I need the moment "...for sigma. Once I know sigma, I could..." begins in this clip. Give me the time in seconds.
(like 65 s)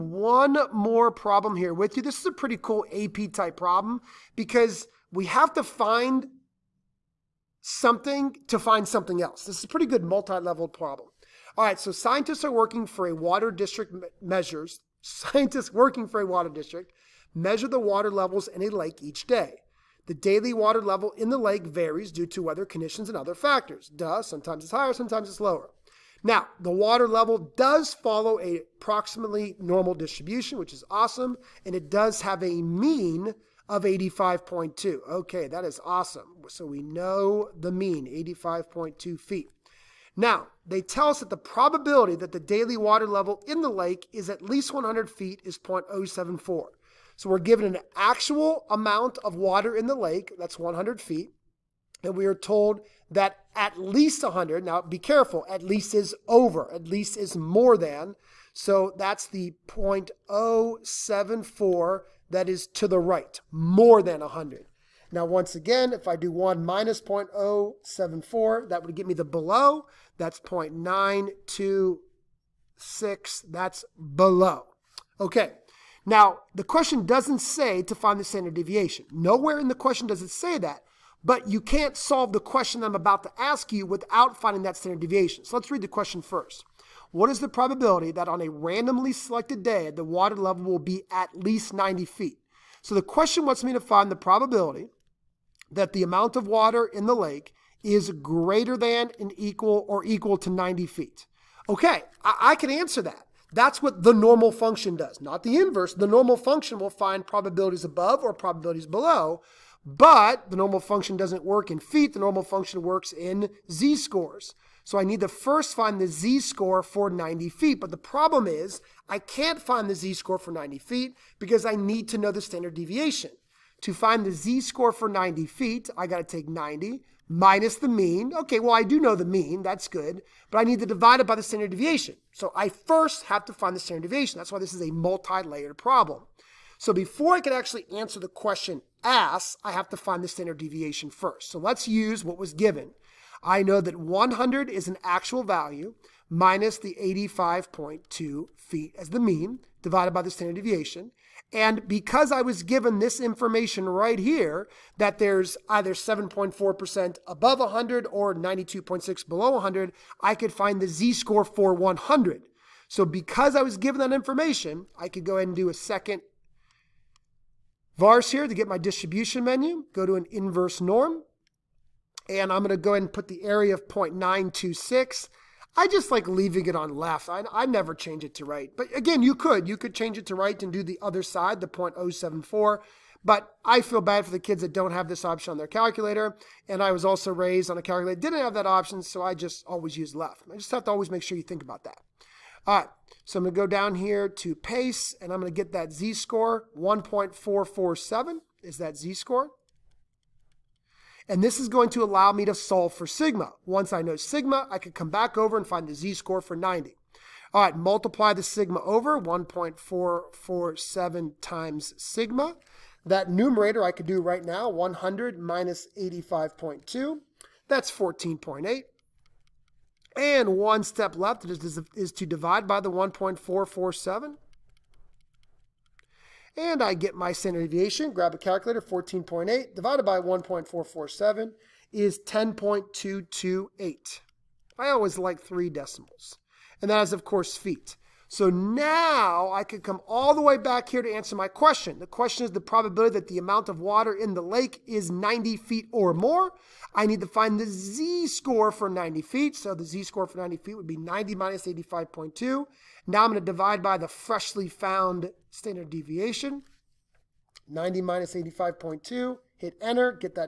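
202 s.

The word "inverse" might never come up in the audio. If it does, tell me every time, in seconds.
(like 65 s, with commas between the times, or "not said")
105 s, 170 s.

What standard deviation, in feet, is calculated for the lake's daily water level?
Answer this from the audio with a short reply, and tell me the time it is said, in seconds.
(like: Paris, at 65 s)
10.228, at 232 s.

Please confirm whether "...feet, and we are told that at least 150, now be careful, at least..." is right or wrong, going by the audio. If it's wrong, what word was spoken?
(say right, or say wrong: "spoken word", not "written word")
wrong: "100", not "150".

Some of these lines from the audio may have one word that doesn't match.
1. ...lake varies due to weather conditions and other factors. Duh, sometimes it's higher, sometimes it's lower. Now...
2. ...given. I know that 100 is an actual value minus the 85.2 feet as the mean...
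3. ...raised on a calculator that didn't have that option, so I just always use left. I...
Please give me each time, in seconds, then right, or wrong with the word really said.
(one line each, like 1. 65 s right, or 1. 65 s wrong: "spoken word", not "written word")
1. 21 s right
2. 142 s right
3. 187 s right.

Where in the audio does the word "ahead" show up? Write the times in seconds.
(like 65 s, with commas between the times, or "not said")
165 s, 172 s.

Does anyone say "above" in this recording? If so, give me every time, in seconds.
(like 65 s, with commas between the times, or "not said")
107 s, 157 s.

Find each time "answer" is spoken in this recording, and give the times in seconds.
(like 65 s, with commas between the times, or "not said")
102 s, 137 s, 241 s.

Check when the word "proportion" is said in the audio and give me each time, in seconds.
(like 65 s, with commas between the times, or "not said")
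not said.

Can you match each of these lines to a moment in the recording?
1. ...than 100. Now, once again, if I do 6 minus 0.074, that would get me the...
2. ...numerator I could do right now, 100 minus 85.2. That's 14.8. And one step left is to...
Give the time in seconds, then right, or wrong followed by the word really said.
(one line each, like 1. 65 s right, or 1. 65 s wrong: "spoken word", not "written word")
1. 64 s wrong: "1", not "6"
2. 213 s right.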